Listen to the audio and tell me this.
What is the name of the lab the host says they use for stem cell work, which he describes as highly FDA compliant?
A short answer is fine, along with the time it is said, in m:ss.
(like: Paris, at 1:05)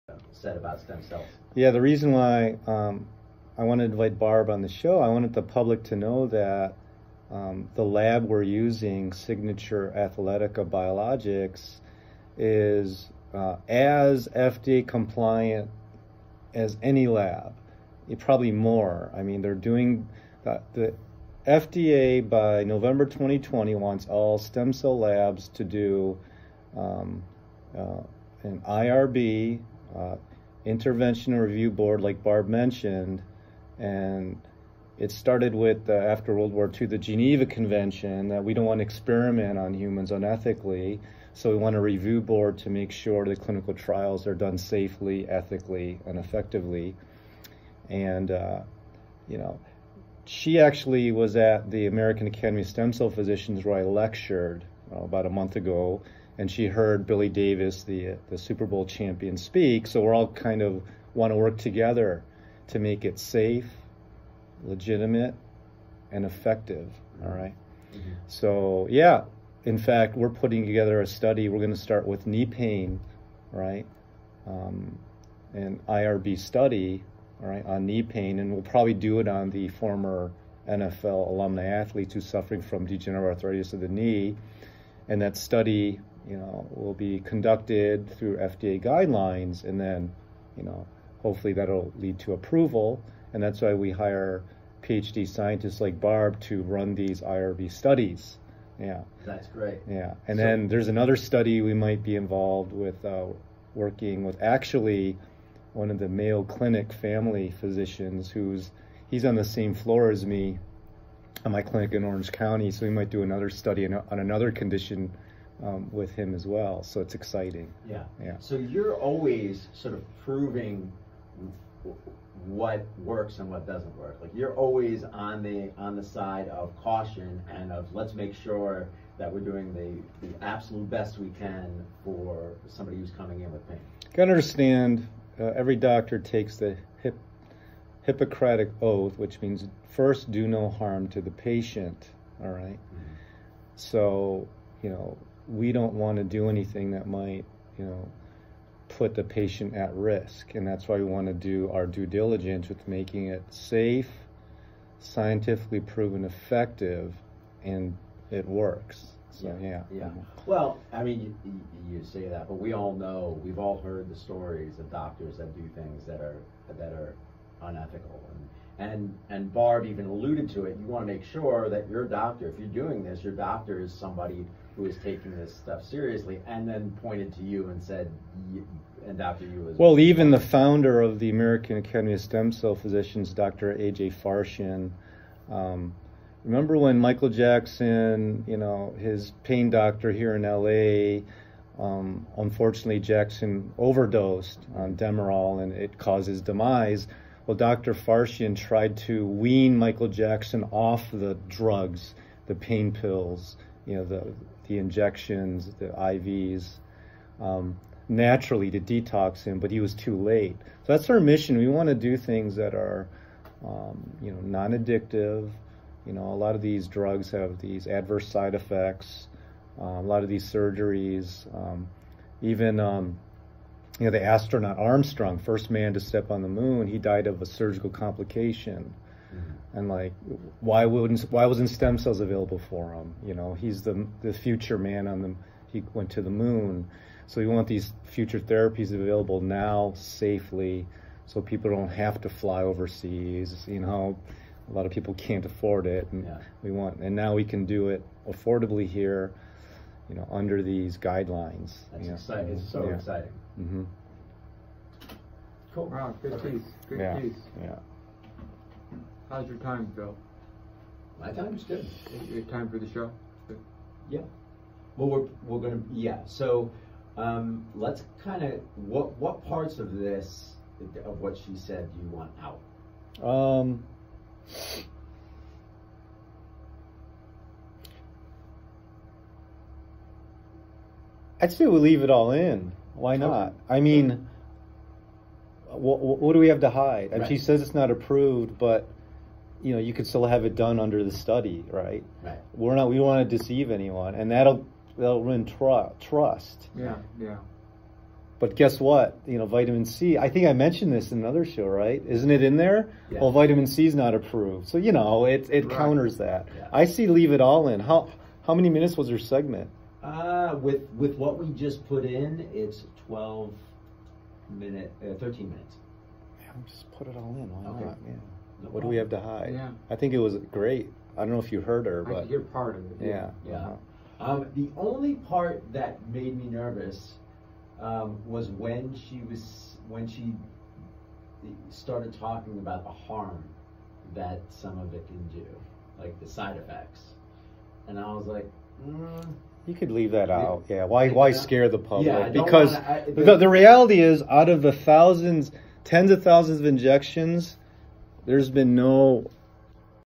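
Signature Athletica Biologics, at 0:09.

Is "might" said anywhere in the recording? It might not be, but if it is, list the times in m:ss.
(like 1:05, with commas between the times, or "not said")
1:41, 1:52, 2:27.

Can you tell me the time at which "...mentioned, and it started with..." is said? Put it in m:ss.
0:32.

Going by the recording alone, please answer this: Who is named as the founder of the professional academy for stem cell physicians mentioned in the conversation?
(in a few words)
Dr. A.J. Farshchian.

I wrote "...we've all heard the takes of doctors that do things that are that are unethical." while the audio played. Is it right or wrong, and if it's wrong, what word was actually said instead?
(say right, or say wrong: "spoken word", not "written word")
wrong: "stories", not "takes".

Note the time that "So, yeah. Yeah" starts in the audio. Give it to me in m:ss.
2:39.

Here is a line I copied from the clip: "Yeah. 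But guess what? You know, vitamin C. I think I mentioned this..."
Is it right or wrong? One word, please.
right.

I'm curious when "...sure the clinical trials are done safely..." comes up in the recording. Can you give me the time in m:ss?
0:42.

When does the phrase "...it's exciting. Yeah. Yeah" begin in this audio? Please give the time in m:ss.
1:57.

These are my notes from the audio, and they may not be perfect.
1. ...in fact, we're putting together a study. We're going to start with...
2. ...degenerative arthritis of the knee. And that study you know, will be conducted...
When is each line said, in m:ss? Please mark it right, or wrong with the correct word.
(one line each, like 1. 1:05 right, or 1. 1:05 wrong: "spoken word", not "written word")
1. 1:09 right
2. 1:22 right.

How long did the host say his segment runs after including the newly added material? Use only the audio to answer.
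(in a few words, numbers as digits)
13 minutes.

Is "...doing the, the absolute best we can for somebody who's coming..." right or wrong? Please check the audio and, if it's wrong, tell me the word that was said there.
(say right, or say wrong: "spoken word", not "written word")
right.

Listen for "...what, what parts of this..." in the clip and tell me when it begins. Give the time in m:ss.
4:28.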